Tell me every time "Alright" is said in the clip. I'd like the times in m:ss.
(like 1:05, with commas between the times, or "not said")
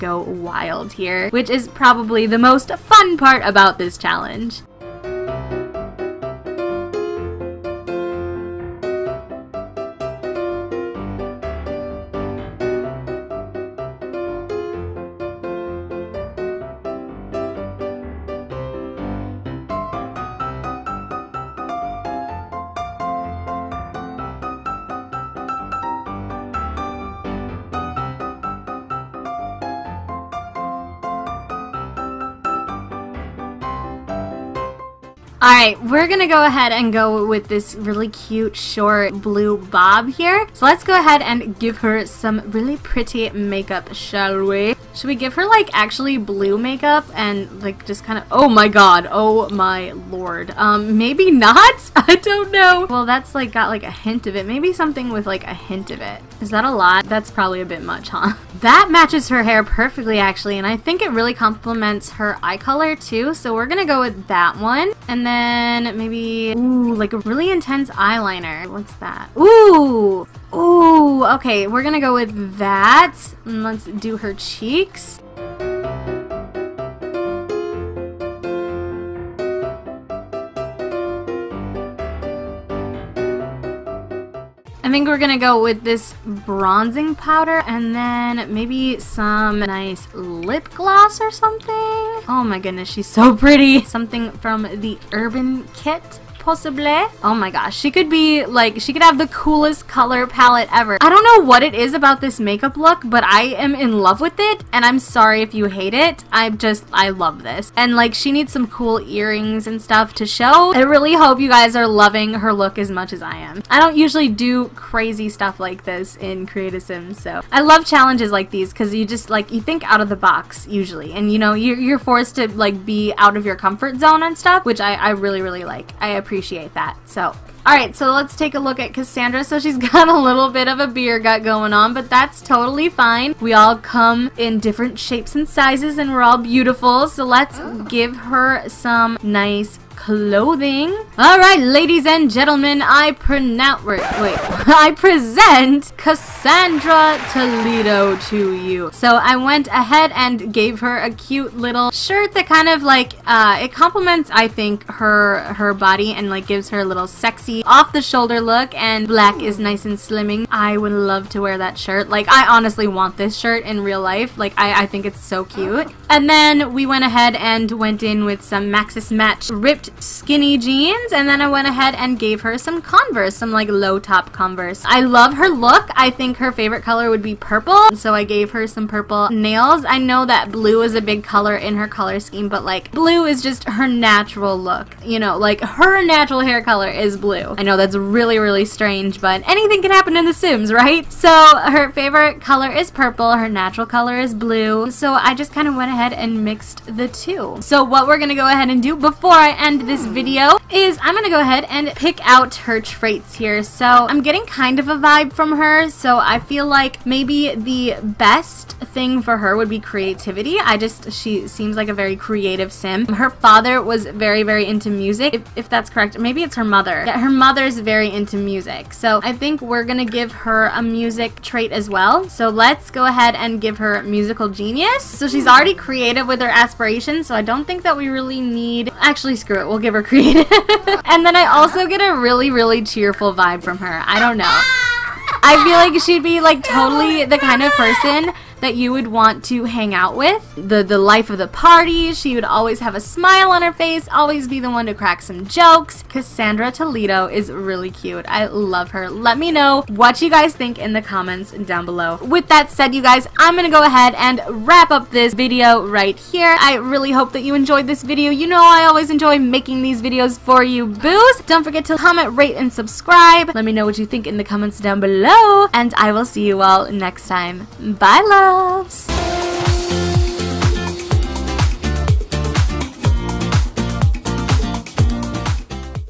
0:35, 2:21.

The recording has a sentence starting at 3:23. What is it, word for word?
So I'm getting kind of a vibe from her, so I feel like maybe the best thing for her would be creativity.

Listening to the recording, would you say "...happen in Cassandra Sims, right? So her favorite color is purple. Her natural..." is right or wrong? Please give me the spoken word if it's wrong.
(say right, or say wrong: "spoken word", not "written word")
wrong: "The", not "Cassandra".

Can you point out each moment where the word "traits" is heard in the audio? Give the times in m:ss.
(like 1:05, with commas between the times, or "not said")
3:22, 3:41.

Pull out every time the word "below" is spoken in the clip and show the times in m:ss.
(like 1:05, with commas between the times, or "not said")
4:11, 4:25.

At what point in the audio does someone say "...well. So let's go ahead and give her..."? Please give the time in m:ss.
3:41.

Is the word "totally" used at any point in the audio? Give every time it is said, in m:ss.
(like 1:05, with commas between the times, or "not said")
2:12, 3:56.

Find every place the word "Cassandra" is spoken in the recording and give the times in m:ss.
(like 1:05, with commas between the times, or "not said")
2:08, 2:25, 4:06.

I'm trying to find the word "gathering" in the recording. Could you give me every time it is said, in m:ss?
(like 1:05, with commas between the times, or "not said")
not said.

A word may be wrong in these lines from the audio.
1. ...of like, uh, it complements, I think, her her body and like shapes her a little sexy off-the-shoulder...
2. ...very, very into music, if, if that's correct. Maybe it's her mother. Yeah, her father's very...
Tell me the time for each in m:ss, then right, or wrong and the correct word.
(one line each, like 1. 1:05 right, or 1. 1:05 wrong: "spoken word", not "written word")
1. 2:32 wrong: "gives", not "shapes"
2. 3:34 wrong: "mother", not "father".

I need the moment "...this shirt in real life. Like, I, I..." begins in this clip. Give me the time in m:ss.
2:43.